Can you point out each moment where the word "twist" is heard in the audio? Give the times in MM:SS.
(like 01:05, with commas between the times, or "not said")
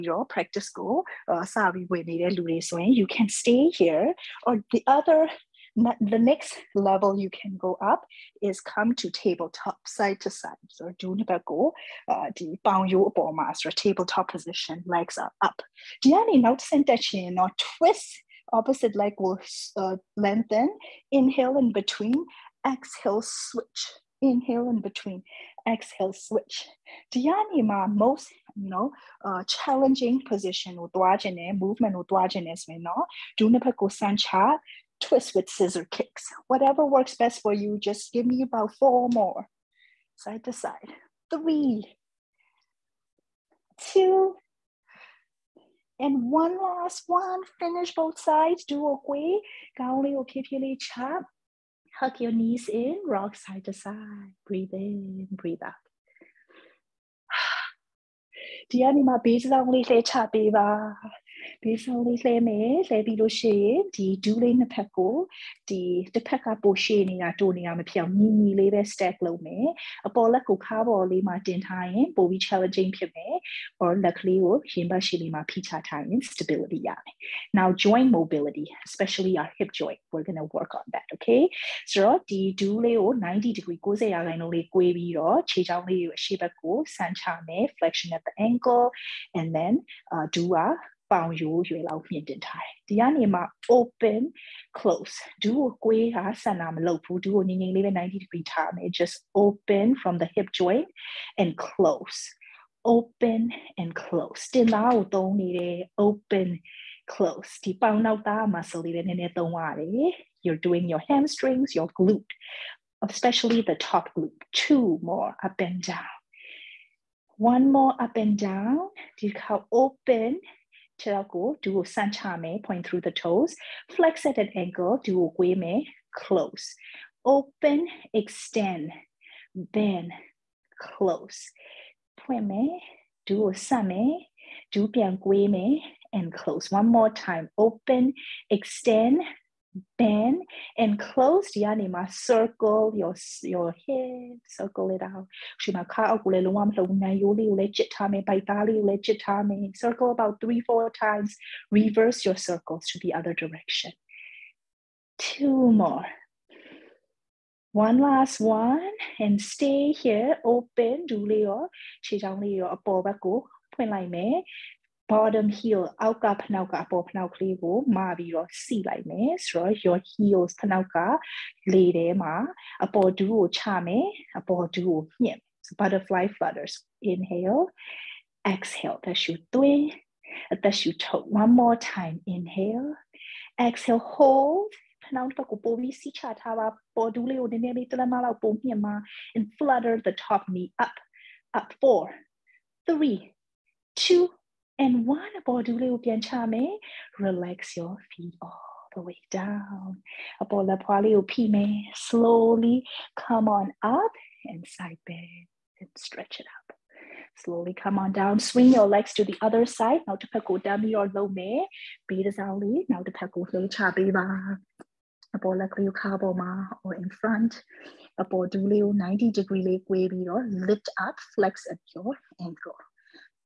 00:17, 00:35.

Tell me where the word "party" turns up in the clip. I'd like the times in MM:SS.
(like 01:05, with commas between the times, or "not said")
not said.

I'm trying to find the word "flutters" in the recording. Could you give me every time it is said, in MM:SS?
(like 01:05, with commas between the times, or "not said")
02:56, 03:09.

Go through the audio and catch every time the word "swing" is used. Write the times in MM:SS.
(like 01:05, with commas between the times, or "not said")
03:28.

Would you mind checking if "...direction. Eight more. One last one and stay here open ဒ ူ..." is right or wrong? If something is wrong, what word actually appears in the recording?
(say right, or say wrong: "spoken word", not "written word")
wrong: "Two", not "Eight".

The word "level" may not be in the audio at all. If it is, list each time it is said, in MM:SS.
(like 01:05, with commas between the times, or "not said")
00:06.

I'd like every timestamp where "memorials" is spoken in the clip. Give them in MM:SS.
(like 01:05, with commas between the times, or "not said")
not said.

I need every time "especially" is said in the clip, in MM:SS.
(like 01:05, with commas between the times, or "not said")
01:18, 01:53.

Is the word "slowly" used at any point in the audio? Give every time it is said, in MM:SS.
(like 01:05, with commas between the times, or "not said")
03:22, 03:27.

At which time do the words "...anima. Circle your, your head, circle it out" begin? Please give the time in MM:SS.
02:21.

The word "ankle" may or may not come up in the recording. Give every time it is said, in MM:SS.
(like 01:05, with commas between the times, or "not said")
01:28, 03:42.